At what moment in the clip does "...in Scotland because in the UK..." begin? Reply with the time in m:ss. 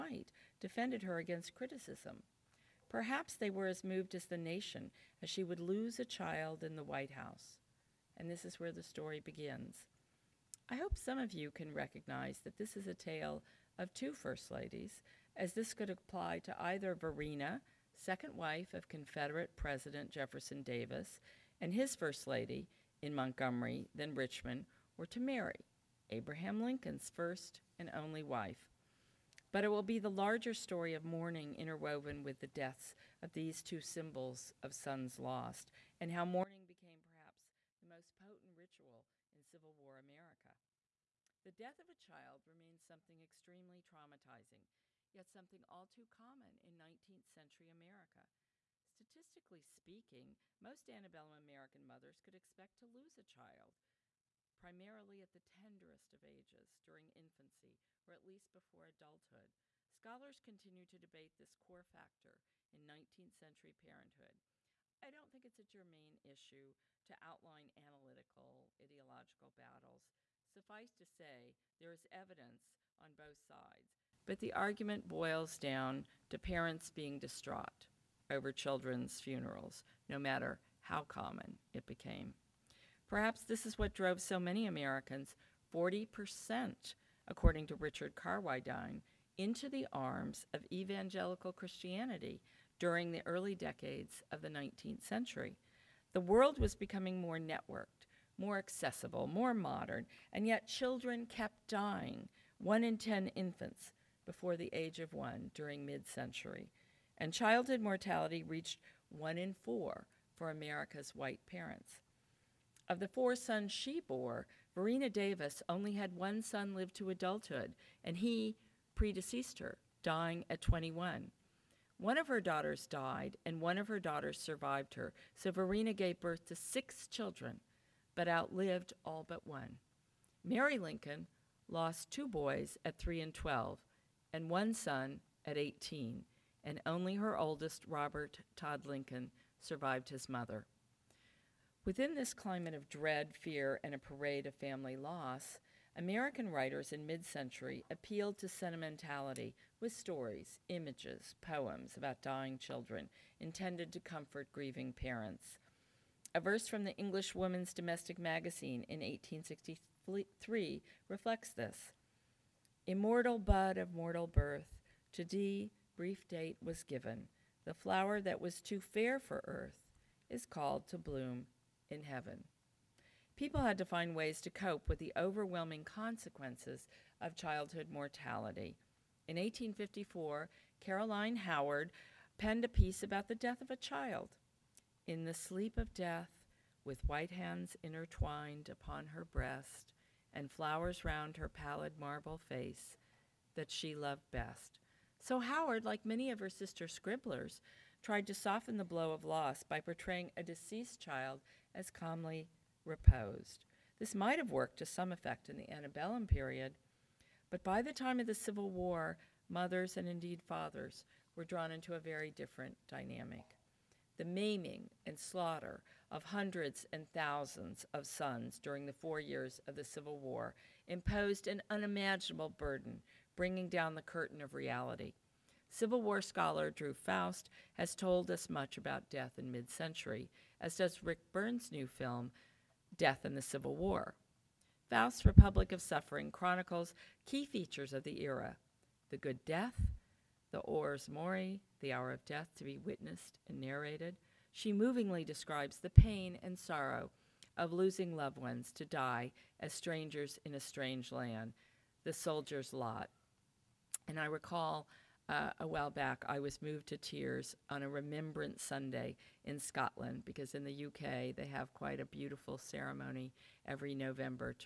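4:19.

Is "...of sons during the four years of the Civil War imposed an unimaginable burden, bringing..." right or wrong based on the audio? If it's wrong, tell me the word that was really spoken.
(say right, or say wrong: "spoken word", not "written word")
right.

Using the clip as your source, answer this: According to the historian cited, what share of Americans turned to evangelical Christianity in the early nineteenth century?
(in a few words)
40%.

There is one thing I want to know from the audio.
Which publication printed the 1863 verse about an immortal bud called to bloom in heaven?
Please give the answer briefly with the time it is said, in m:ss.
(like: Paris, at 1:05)
English Woman's Domestic Magazine, at 2:36.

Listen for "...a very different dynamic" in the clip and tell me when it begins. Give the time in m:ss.
3:31.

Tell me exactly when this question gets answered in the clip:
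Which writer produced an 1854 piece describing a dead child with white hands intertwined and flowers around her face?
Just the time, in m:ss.
3:00.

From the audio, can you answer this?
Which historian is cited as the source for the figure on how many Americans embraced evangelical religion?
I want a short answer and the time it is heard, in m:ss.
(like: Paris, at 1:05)
Richard Carwardine, at 1:27.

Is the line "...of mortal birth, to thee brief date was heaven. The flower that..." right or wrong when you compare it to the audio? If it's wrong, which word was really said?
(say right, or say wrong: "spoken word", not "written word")
wrong: "given", not "heaven".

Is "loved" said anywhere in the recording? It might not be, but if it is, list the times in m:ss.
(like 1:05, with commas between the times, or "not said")
3:13, 4:08.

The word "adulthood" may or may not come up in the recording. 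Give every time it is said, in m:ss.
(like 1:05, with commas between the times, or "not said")
0:58, 1:57.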